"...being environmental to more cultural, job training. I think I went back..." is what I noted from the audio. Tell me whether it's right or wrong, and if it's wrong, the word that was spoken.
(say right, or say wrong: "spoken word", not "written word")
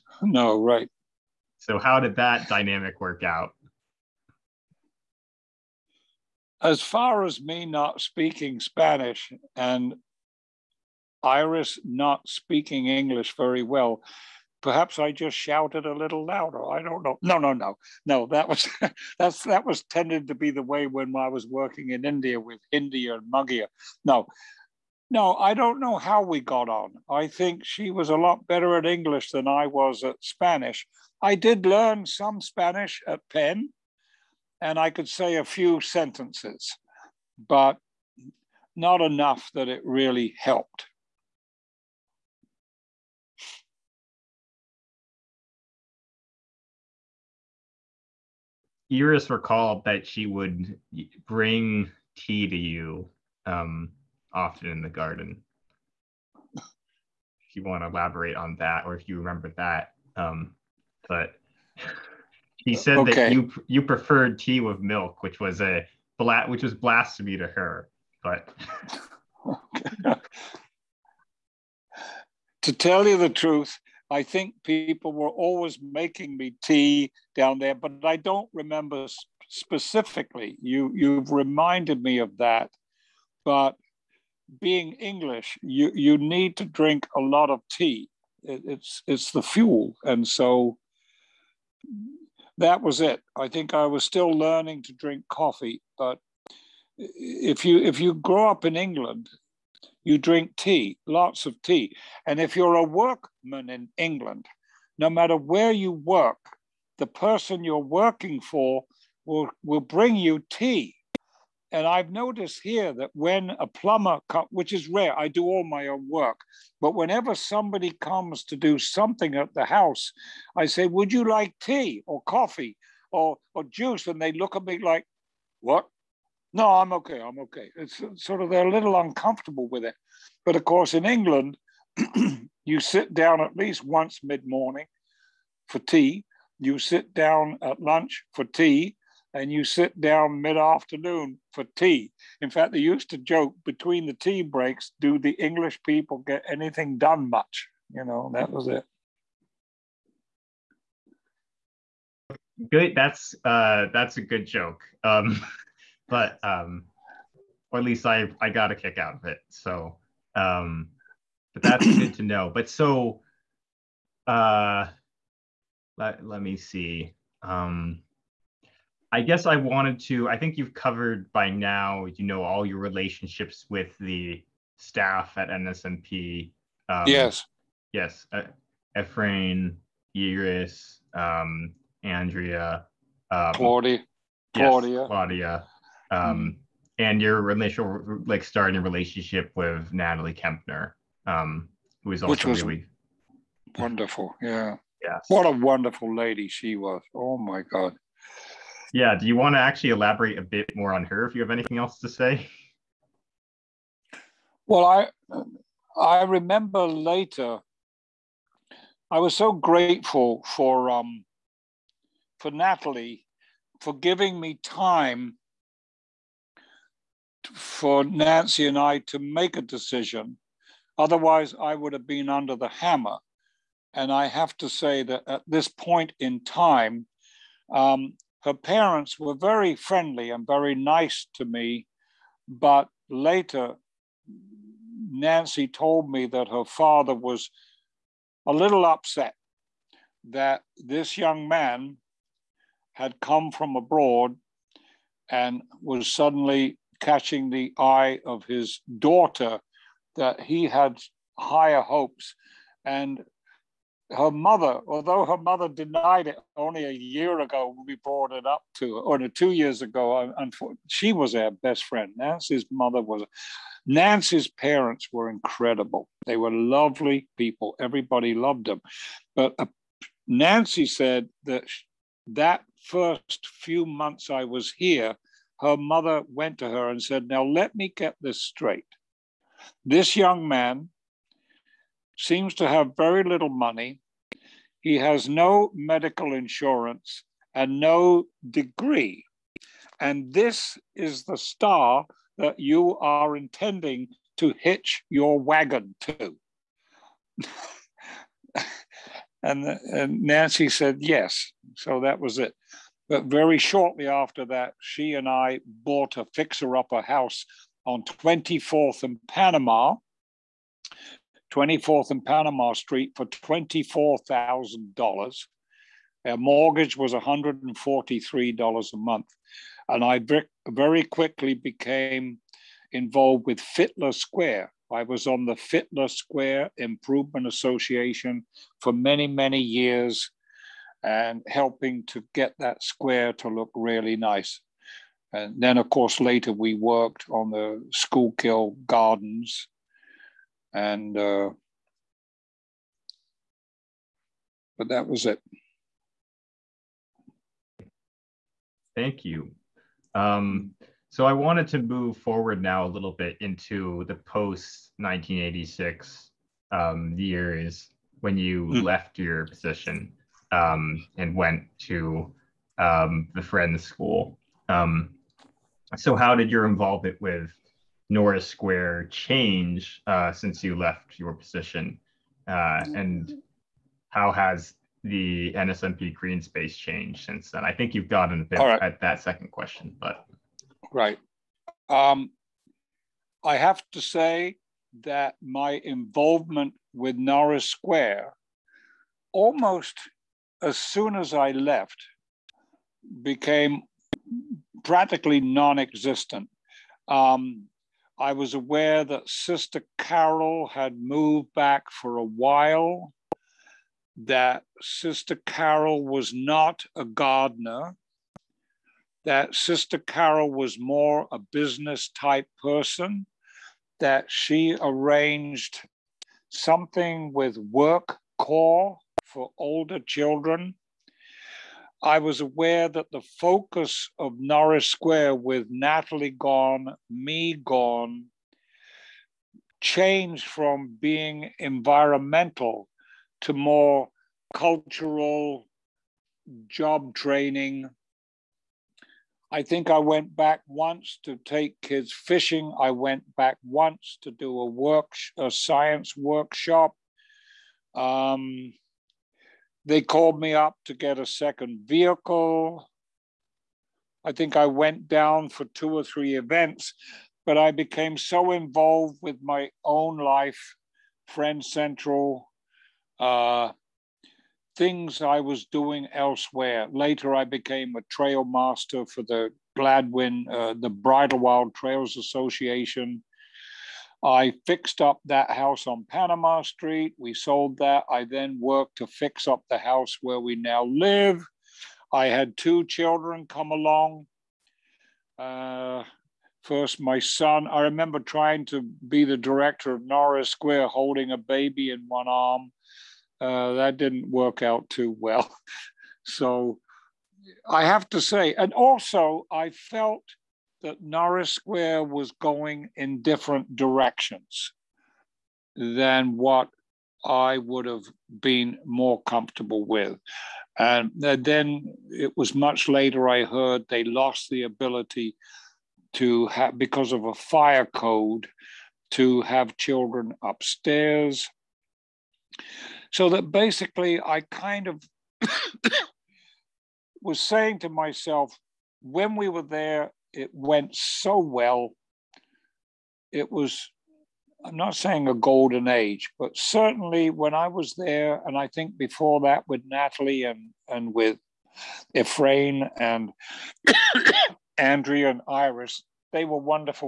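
right.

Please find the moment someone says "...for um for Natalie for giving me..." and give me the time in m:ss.
3:30.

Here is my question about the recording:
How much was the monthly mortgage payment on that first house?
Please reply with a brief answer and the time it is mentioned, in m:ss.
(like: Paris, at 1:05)
$143, at 5:17.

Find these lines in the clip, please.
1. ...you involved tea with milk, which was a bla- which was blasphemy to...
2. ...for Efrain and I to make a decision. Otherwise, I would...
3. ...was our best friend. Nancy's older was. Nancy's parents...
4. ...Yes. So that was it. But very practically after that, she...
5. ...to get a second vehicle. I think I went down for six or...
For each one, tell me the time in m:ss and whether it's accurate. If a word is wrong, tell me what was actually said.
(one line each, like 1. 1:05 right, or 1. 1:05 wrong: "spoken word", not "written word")
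1. 1:03 wrong: "preferred", not "involved"
2. 3:37 wrong: "Nancy", not "Efrain"
3. 4:21 wrong: "mother", not "older"
4. 5:00 wrong: "shortly", not "practically"
5. 7:30 wrong: "two", not "six".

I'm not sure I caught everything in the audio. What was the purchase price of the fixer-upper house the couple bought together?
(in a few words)
$24,000.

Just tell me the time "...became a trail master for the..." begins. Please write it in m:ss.
7:47.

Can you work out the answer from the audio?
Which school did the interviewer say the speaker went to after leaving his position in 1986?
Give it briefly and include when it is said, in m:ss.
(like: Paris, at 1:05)
Friends School, at 6:03.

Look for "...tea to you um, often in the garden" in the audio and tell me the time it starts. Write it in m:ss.
0:52.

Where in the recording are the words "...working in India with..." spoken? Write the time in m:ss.
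0:21.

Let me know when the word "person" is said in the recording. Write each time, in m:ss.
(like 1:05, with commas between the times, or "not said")
1:47, 6:52.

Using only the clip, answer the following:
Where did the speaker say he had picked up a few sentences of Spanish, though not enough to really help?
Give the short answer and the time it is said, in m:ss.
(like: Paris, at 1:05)
Penn, at 0:33.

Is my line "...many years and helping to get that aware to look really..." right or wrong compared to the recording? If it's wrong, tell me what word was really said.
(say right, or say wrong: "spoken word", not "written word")
wrong: "square", not "aware".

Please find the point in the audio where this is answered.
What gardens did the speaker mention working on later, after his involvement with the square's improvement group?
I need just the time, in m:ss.
5:37.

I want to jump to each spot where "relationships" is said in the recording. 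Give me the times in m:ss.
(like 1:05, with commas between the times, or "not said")
2:52, 3:08.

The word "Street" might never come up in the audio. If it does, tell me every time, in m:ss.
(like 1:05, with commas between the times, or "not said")
5:12, 7:56.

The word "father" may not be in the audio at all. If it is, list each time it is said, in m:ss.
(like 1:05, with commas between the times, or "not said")
3:56.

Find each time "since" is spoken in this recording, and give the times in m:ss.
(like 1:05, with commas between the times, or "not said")
6:10, 6:17.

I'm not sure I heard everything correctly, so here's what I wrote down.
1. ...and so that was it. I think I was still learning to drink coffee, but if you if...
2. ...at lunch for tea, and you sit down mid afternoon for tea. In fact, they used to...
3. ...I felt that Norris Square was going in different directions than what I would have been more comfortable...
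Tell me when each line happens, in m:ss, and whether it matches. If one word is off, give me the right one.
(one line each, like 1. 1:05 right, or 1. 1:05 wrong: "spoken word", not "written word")
1. 1:30 right
2. 2:17 right
3. 8:19 right.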